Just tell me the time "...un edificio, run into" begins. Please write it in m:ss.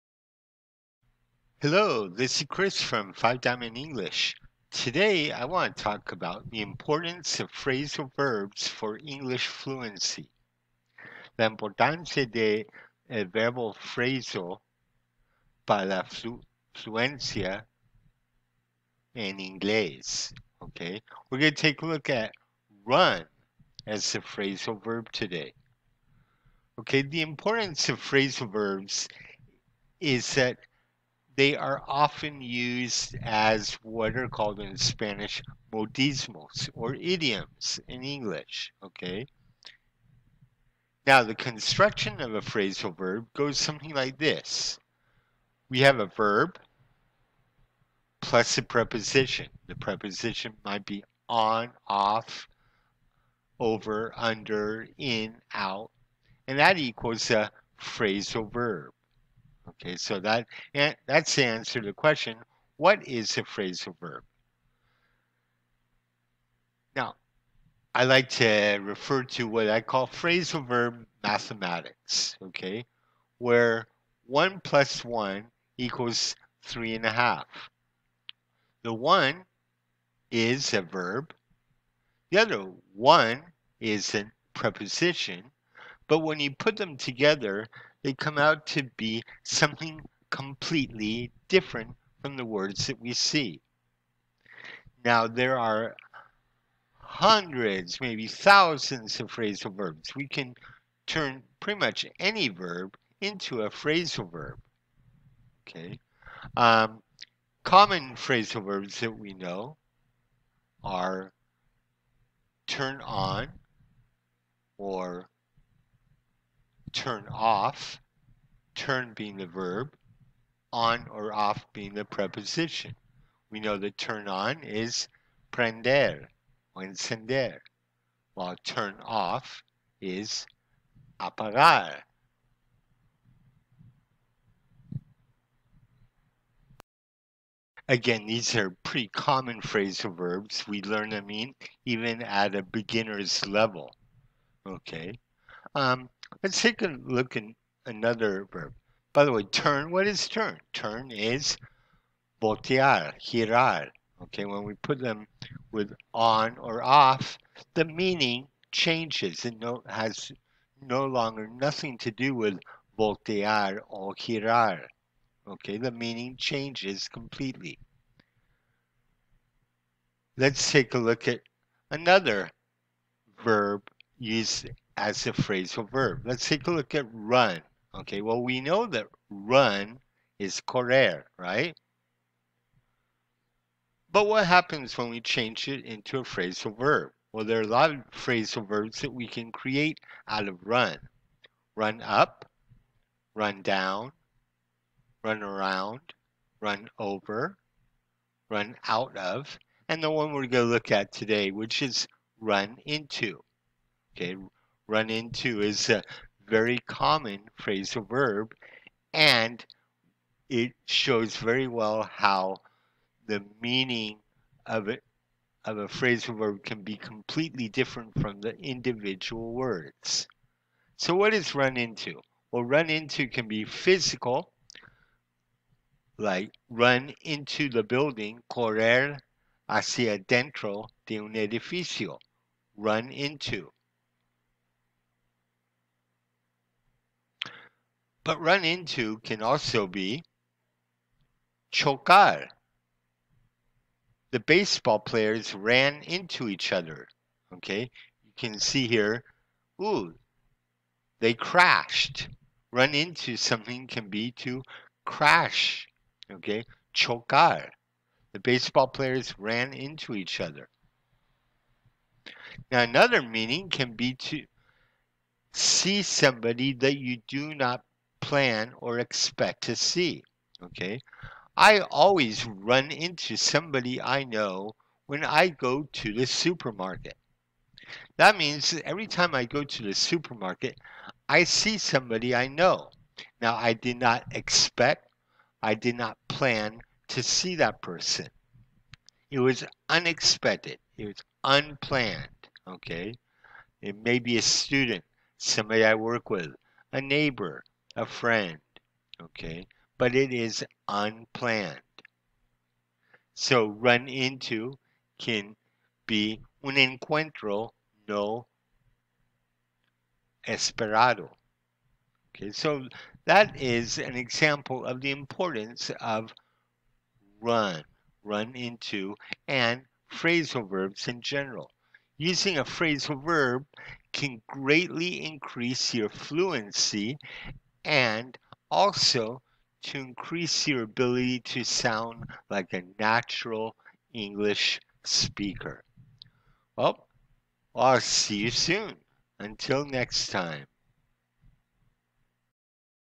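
3:51.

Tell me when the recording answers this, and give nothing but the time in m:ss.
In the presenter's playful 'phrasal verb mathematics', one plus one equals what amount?
1:16.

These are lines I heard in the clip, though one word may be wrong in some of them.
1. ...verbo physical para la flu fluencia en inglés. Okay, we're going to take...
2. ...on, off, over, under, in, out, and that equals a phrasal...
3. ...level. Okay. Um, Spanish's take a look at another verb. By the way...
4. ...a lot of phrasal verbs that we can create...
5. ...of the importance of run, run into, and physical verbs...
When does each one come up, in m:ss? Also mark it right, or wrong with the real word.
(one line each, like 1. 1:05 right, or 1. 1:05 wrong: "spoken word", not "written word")
1. 0:13 wrong: "phrasal", not "physical"
2. 0:51 right
3. 2:23 wrong: "Let", not "Spanish"
4. 3:07 right
5. 5:14 wrong: "phrasal", not "physical".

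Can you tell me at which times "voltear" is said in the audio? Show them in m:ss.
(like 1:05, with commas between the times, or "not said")
2:32, 2:42.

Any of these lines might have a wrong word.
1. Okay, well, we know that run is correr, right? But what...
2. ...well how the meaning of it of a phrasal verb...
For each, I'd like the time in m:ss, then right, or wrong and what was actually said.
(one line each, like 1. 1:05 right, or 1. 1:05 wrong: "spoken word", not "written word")
1. 2:57 right
2. 3:31 right.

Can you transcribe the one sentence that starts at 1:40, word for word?
We can turn pretty much any verb into a phrasal verb.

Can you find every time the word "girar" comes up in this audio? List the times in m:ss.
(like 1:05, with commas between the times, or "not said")
2:33, 2:44.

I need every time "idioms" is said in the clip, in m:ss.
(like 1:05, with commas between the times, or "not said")
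0:36.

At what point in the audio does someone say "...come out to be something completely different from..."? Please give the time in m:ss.
1:28.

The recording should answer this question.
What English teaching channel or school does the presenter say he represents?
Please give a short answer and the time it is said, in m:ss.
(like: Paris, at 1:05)
Five Diamond English, at 0:03.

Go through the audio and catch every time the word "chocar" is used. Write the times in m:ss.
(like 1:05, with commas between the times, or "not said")
4:01, 4:16.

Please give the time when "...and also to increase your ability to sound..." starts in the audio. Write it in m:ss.
5:27.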